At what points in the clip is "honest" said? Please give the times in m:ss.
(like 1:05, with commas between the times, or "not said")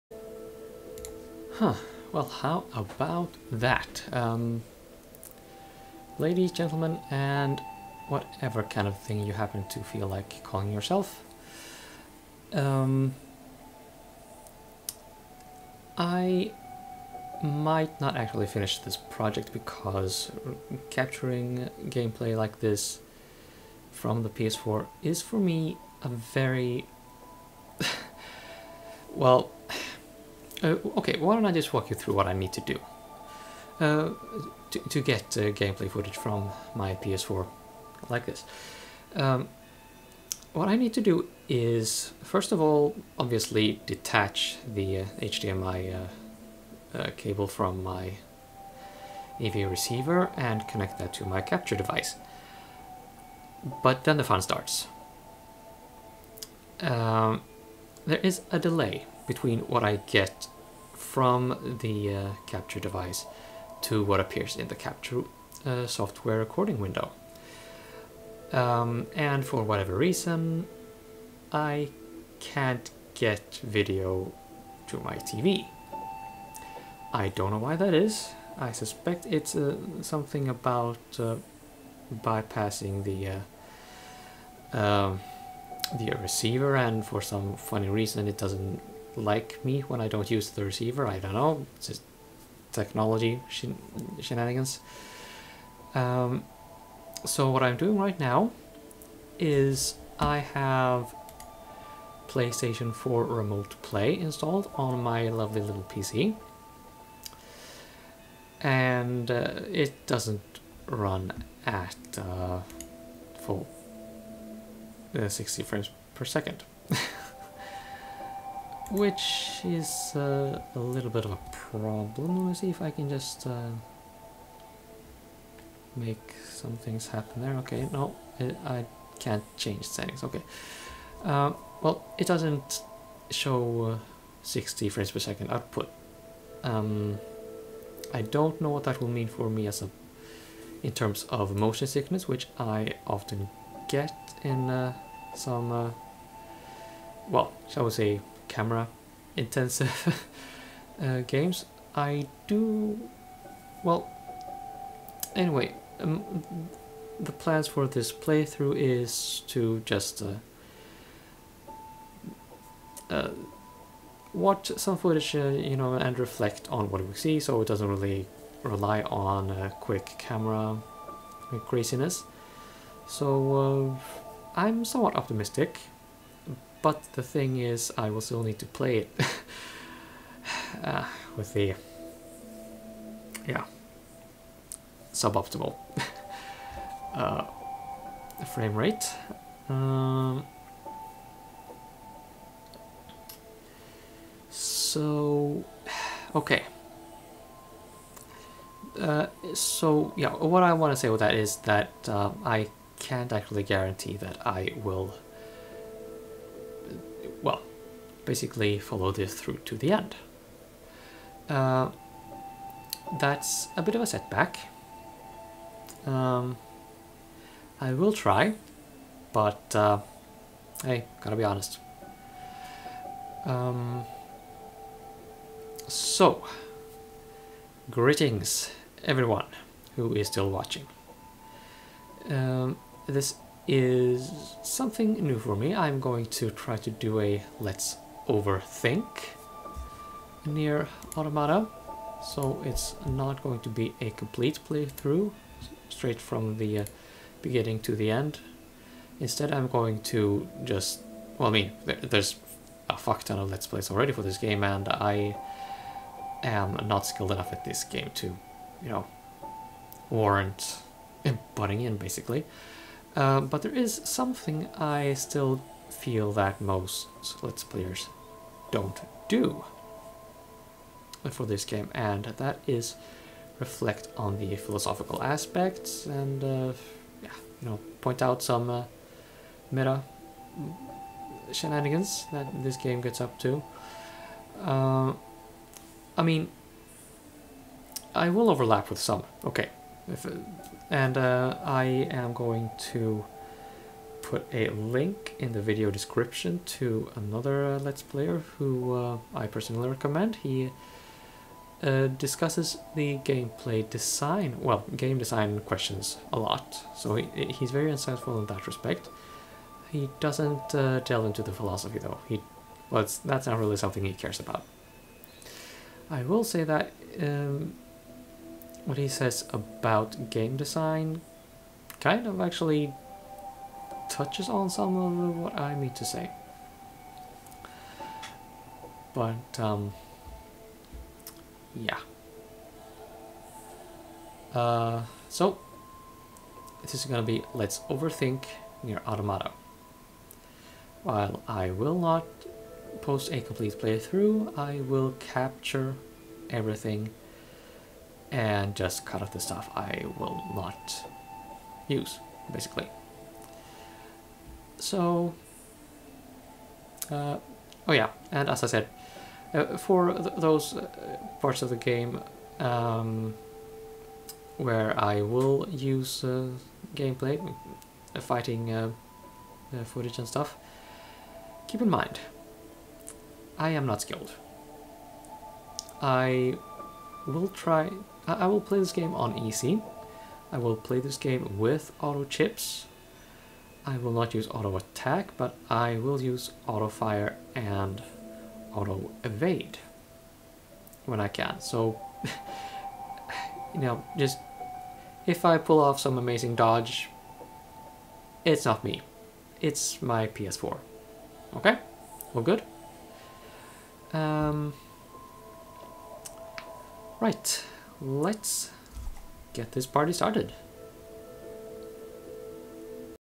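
3:41.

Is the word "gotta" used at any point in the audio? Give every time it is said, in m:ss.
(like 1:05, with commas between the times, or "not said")
3:41.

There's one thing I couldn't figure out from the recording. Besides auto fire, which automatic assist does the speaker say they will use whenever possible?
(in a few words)
auto evade.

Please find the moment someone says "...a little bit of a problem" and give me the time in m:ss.
2:00.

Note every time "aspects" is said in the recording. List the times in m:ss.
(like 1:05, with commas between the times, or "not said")
4:35.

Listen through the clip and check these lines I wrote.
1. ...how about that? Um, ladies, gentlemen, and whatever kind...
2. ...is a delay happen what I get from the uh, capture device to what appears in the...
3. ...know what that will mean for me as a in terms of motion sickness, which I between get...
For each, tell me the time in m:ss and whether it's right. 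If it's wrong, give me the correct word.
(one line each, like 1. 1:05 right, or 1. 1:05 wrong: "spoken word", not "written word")
1. 0:02 right
2. 0:58 wrong: "between", not "happen"
3. 2:18 wrong: "often", not "between".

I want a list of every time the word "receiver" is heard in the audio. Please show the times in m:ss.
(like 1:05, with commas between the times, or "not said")
0:49, 1:26, 1:30.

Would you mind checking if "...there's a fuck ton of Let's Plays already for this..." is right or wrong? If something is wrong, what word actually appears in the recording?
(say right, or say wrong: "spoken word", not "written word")
right.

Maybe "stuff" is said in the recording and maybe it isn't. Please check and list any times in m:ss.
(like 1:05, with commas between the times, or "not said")
5:49, 6:10.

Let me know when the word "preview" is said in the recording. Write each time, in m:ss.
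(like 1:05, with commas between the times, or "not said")
not said.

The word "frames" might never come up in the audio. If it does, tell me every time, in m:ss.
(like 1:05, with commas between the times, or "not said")
1:55, 2:14, 3:08.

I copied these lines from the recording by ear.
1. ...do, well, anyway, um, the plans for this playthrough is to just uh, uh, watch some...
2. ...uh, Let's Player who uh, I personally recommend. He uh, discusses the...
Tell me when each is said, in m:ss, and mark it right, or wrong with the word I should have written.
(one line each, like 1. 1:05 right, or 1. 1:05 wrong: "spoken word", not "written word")
1. 2:32 right
2. 4:57 right.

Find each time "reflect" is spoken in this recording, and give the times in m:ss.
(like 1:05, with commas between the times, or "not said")
2:46, 4:33.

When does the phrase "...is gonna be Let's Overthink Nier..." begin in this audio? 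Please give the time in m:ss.
5:36.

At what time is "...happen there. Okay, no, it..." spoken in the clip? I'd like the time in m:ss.
2:07.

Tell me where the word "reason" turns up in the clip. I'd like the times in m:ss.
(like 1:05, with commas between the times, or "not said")
1:09, 1:27.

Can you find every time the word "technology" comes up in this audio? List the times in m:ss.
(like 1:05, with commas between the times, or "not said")
1:32.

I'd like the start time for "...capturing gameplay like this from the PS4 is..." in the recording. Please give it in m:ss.
0:20.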